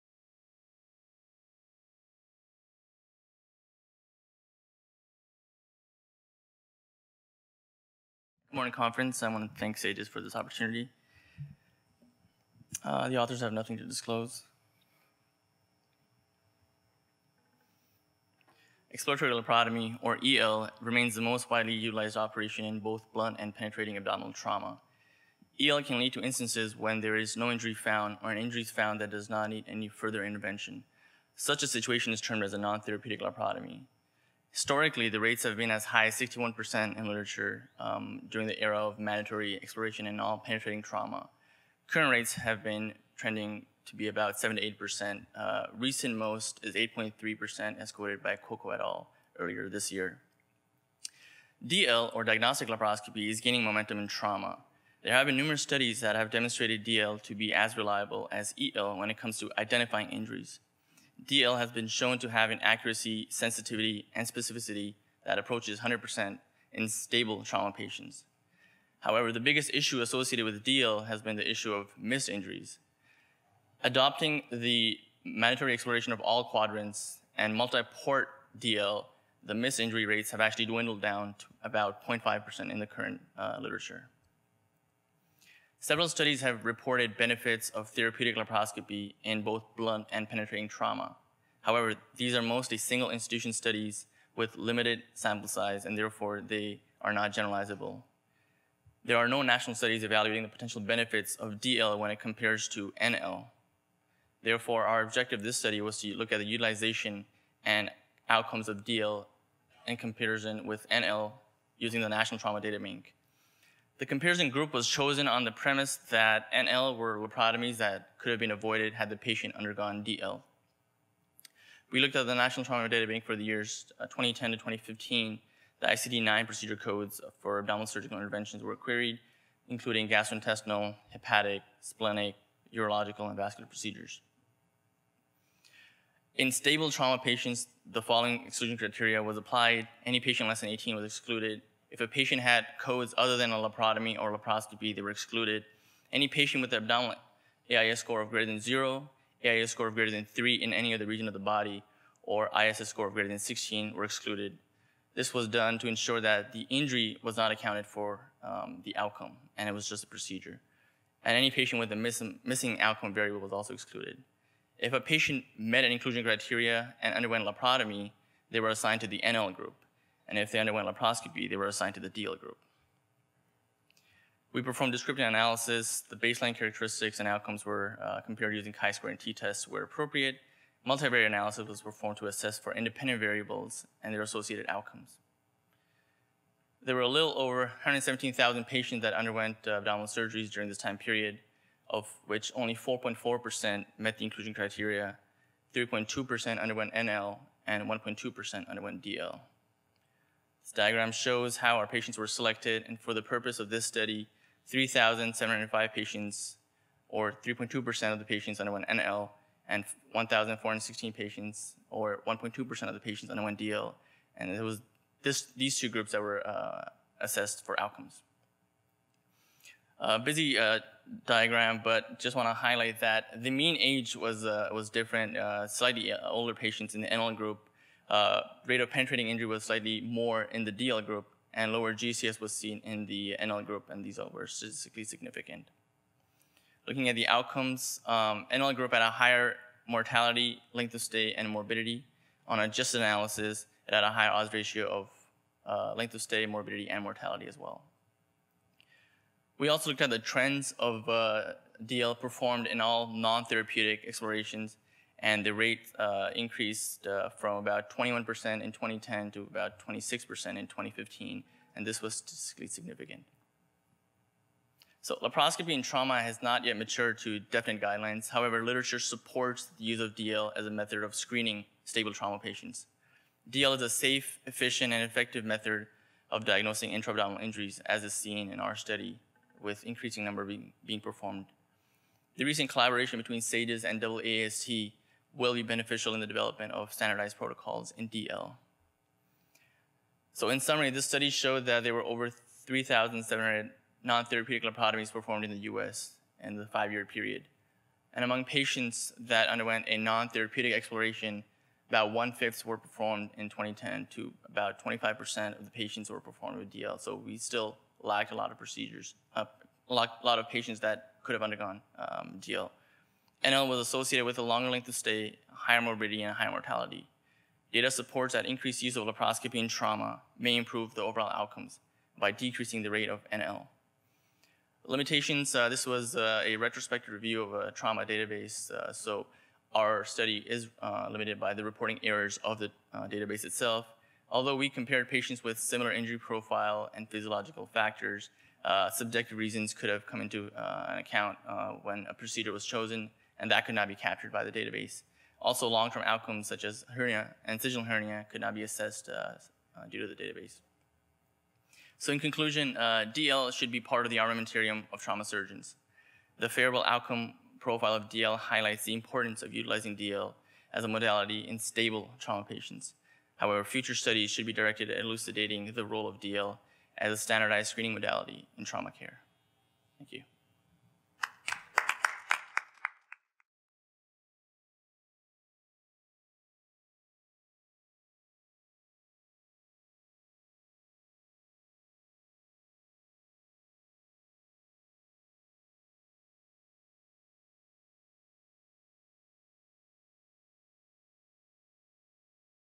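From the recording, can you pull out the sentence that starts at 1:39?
There are no national studies evaluating the potential benefits of DL when it compares to NL.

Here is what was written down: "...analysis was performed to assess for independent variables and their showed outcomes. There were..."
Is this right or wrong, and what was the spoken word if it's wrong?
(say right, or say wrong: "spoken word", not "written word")
wrong: "associated", not "showed".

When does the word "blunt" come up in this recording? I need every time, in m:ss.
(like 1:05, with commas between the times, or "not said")
0:23, 1:29.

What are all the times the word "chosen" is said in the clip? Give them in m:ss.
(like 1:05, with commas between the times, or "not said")
1:54, 5:42.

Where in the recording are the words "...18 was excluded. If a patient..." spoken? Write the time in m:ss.
2:20.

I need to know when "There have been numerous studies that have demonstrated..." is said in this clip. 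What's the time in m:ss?
0:55.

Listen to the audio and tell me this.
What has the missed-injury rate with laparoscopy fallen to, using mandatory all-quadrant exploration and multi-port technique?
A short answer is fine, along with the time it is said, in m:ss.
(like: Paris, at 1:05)
0.5%, at 1:22.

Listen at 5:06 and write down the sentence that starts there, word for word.
So we still lacked a lot of procedures, uh, a lot, of patients that could have undergone um, DL.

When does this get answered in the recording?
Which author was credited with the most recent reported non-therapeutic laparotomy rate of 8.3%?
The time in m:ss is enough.
0:48.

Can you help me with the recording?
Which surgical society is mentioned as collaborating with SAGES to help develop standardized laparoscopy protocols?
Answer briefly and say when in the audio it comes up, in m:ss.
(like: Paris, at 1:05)
AAST, at 4:44.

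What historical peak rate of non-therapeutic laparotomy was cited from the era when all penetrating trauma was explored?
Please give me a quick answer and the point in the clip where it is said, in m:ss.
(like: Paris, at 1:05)
61%, at 0:36.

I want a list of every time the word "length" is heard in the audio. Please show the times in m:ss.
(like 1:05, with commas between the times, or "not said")
4:00, 4:05, 5:14.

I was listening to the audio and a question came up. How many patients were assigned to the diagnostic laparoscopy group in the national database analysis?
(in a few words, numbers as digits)
1,416.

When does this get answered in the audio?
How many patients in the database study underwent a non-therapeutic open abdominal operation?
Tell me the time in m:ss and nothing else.
3:24.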